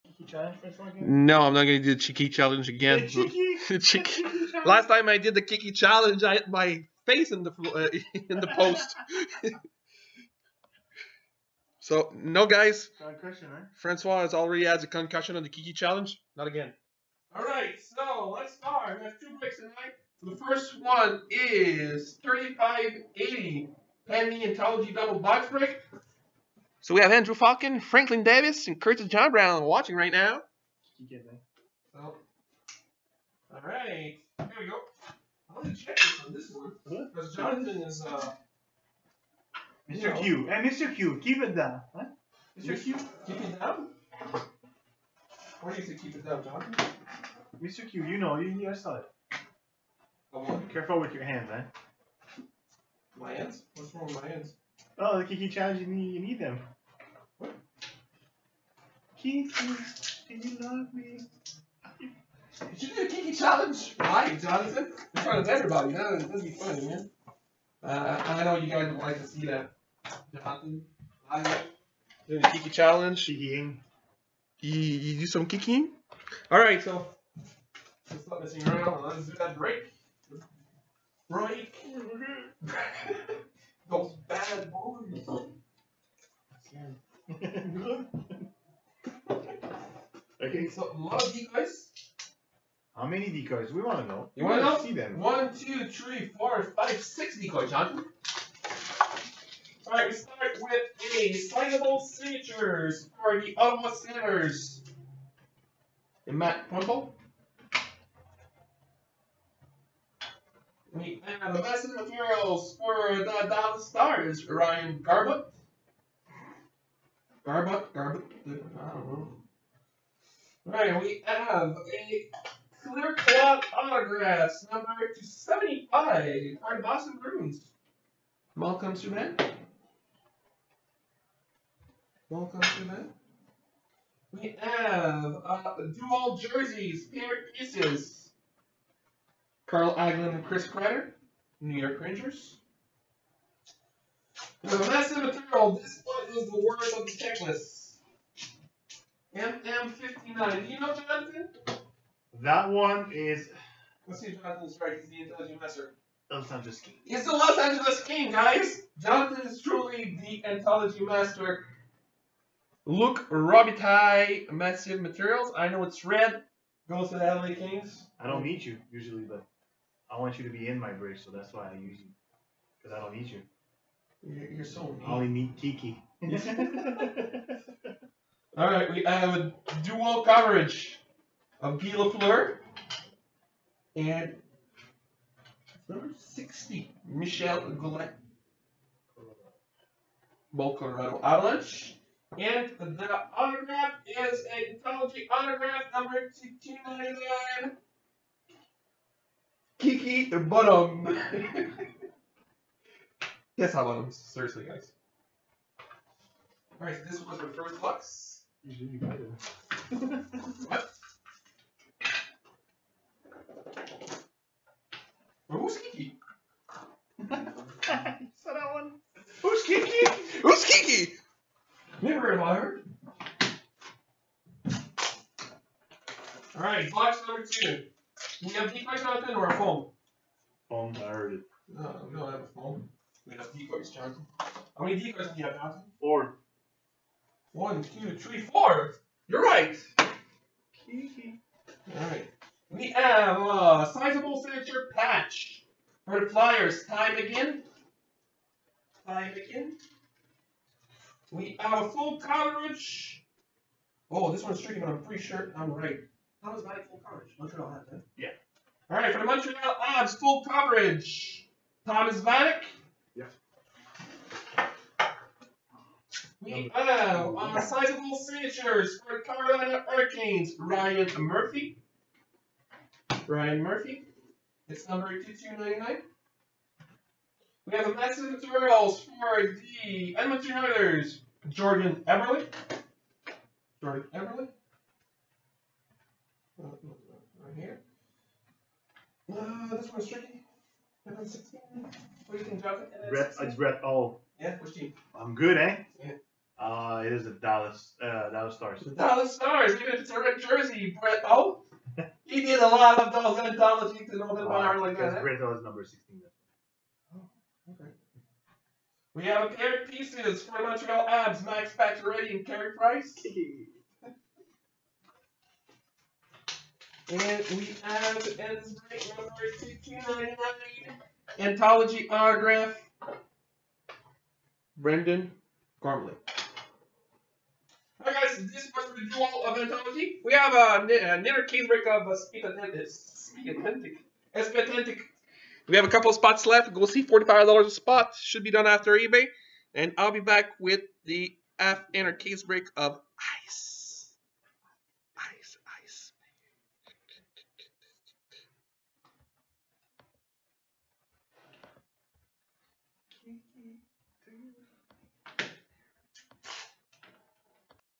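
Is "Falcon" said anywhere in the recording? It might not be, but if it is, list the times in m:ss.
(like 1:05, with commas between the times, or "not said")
0:27.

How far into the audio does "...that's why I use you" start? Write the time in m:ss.
2:51.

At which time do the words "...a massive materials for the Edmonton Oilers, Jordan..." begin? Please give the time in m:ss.
4:37.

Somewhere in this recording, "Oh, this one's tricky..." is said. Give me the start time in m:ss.
4:14.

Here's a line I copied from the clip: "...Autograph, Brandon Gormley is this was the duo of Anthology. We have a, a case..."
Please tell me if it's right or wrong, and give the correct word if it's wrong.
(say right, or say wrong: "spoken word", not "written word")
right.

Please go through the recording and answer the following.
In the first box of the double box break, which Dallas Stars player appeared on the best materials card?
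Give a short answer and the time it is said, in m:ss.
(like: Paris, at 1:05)
Ryan Garbutt, at 1:54.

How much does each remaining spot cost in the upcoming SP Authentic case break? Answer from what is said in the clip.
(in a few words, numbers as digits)
$45.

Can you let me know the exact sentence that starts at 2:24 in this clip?
The massive material, this one is the worst of the checklist.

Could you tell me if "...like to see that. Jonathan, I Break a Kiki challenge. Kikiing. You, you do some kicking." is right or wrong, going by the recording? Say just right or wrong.
wrong.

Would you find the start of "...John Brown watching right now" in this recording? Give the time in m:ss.
0:29.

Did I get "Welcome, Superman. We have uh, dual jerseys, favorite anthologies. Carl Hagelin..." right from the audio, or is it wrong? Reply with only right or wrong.
wrong.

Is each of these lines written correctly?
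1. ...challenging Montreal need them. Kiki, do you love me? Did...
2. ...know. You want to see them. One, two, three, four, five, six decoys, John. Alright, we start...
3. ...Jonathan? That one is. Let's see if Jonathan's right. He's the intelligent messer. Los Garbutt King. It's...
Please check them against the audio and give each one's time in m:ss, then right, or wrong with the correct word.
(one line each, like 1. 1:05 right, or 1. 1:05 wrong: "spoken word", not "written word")
1. 0:55 wrong: "You", not "Montreal"
2. 1:34 right
3. 2:30 wrong: "Angeles", not "Garbutt".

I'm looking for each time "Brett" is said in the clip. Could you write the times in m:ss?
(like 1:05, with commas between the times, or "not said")
5:01, 5:05.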